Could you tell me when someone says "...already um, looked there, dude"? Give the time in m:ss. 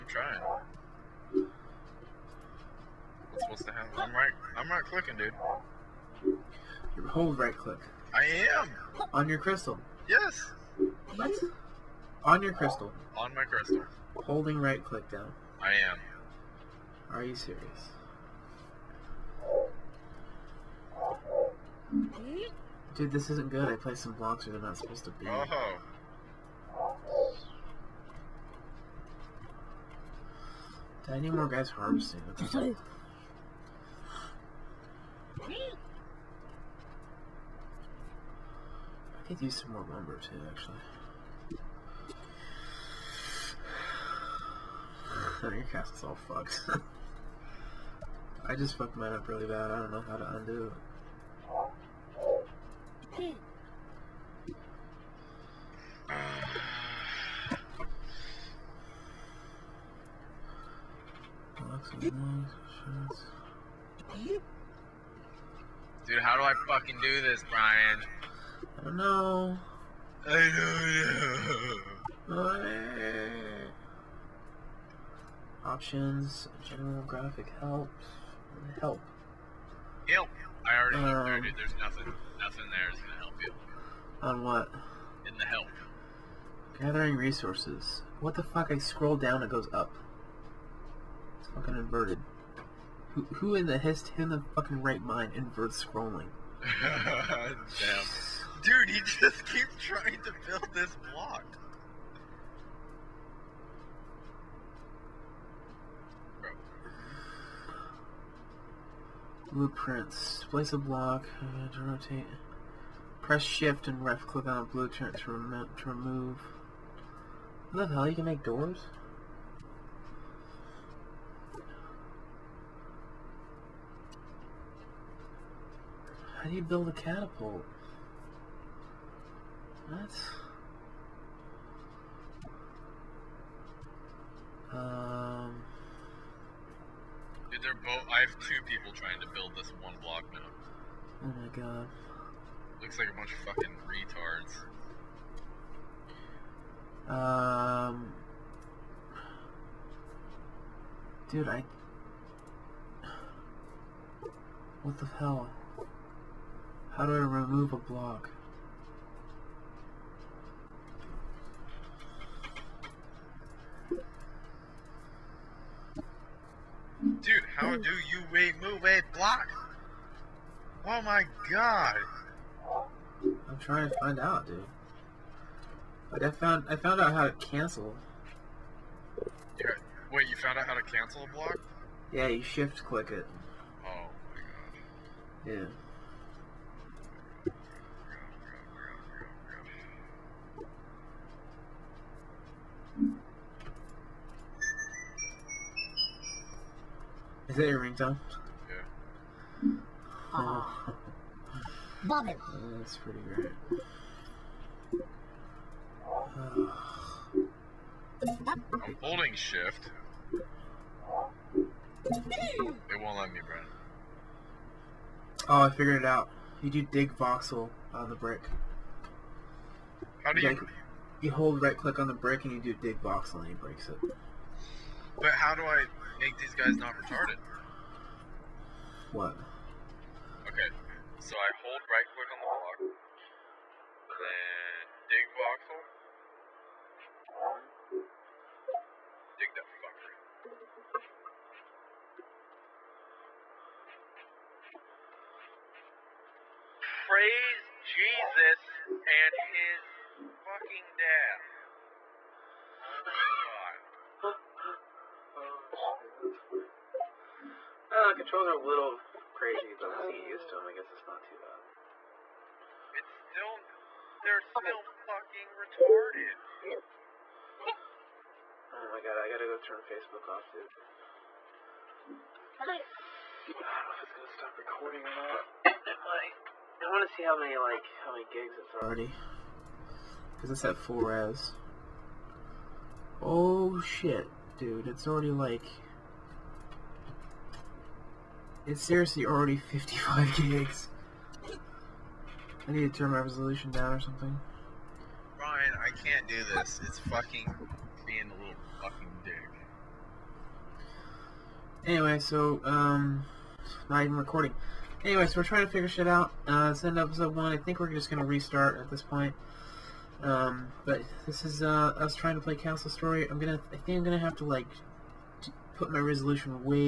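1:20.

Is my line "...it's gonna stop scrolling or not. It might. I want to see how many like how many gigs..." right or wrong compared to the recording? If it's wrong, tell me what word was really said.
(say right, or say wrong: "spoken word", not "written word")
wrong: "recording", not "scrolling".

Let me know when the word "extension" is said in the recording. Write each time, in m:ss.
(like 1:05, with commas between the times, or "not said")
not said.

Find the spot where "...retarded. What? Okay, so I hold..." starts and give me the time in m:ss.
3:47.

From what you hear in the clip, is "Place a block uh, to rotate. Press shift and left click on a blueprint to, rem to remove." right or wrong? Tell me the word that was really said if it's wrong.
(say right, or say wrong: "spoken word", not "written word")
right.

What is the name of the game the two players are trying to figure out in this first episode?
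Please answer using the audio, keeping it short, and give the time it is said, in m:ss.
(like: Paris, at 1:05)
Castle Story, at 5:12.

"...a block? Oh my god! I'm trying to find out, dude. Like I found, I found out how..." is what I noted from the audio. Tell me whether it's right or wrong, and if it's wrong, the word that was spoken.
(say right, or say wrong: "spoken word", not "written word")
right.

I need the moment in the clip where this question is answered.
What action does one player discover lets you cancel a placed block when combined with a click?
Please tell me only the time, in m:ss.
3:02.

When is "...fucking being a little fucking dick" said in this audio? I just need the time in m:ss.
4:56.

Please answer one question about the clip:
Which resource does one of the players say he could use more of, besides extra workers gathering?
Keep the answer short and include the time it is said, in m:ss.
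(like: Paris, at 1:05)
Lumber, at 0:39.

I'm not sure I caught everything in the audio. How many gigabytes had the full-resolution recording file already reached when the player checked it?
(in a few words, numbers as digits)
55.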